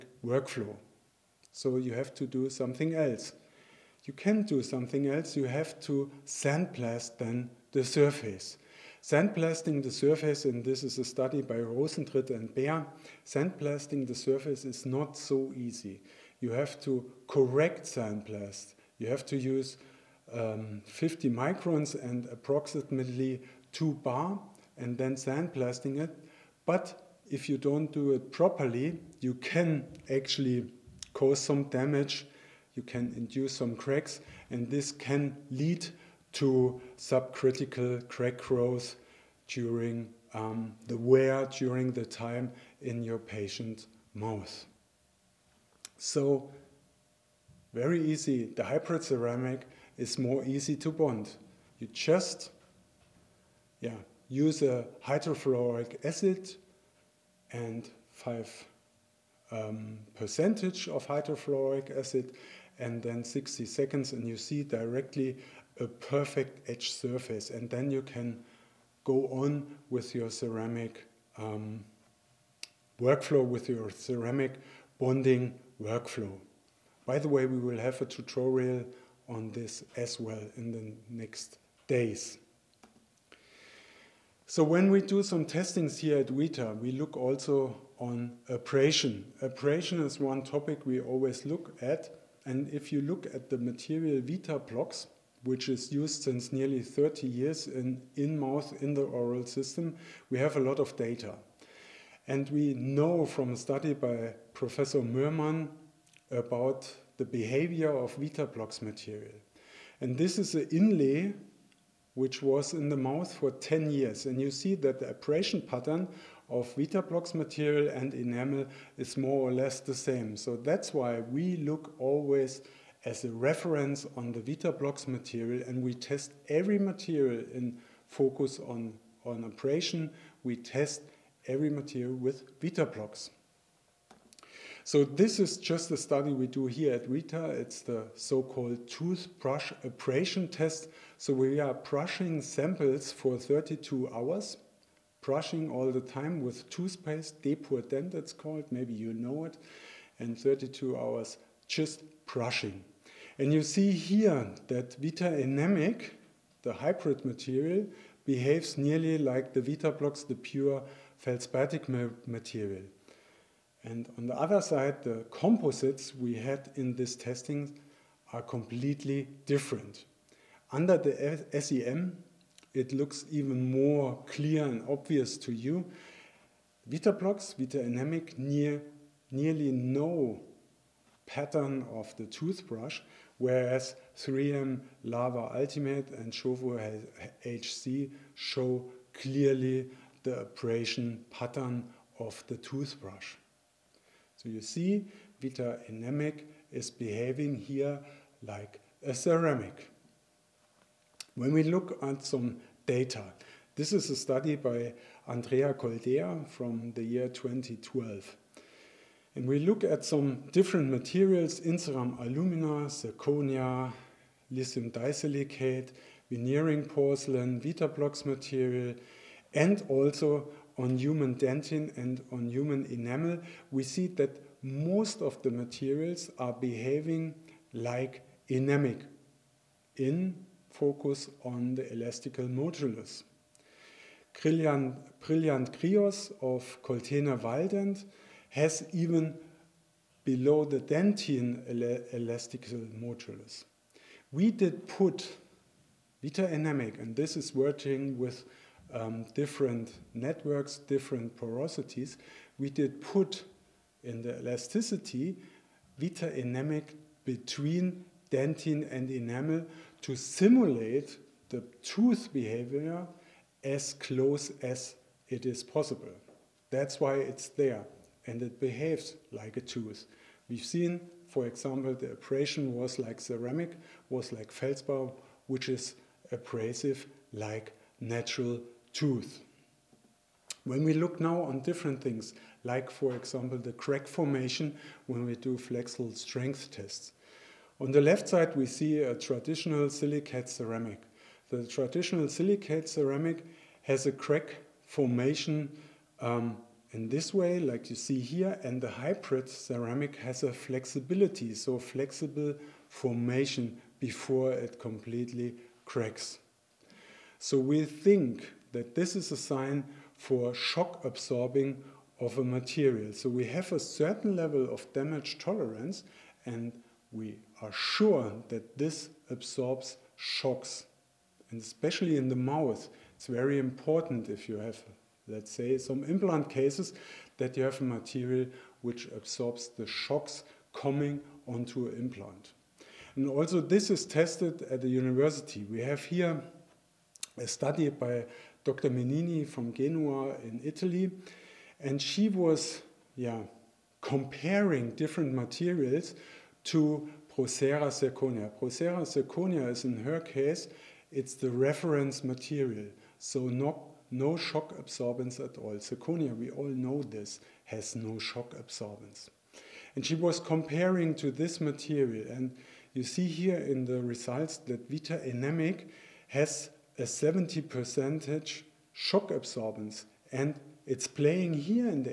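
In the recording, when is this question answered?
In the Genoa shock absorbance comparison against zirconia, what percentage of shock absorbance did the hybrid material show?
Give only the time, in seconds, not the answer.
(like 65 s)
367 s.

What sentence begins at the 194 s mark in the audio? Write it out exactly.
So you see, Vita Enamic is behaving here like a ceramic.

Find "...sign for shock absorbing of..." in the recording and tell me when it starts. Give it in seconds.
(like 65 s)
309 s.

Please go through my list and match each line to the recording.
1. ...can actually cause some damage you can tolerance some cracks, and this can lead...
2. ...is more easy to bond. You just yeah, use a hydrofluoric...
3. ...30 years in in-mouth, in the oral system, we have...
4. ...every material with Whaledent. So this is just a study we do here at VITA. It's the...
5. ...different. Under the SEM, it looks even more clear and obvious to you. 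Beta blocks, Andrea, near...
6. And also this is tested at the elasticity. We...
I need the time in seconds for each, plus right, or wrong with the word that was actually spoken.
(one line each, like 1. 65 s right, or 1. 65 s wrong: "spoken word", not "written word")
1. 29 s wrong: "induce", not "tolerance"
2. 49 s right
3. 96 s right
4. 131 s wrong: "Vitablocs", not "Whaledent"
5. 169 s wrong: "Enamic", not "Andrea"
6. 333 s wrong: "university", not "elasticity".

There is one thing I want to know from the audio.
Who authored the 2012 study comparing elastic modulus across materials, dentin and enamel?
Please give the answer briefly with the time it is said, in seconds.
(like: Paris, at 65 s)
Andrea Coldea, at 205 s.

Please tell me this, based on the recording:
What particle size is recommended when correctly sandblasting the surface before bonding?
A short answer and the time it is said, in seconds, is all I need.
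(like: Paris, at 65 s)
50 microns, at 20 s.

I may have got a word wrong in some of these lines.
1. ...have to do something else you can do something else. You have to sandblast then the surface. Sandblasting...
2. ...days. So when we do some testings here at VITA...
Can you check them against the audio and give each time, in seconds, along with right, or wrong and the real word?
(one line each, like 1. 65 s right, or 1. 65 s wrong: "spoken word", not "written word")
1. 1 s right
2. 81 s right.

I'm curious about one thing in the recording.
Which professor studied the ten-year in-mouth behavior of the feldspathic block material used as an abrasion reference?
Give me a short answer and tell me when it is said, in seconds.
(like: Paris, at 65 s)
Mörmann, at 104 s.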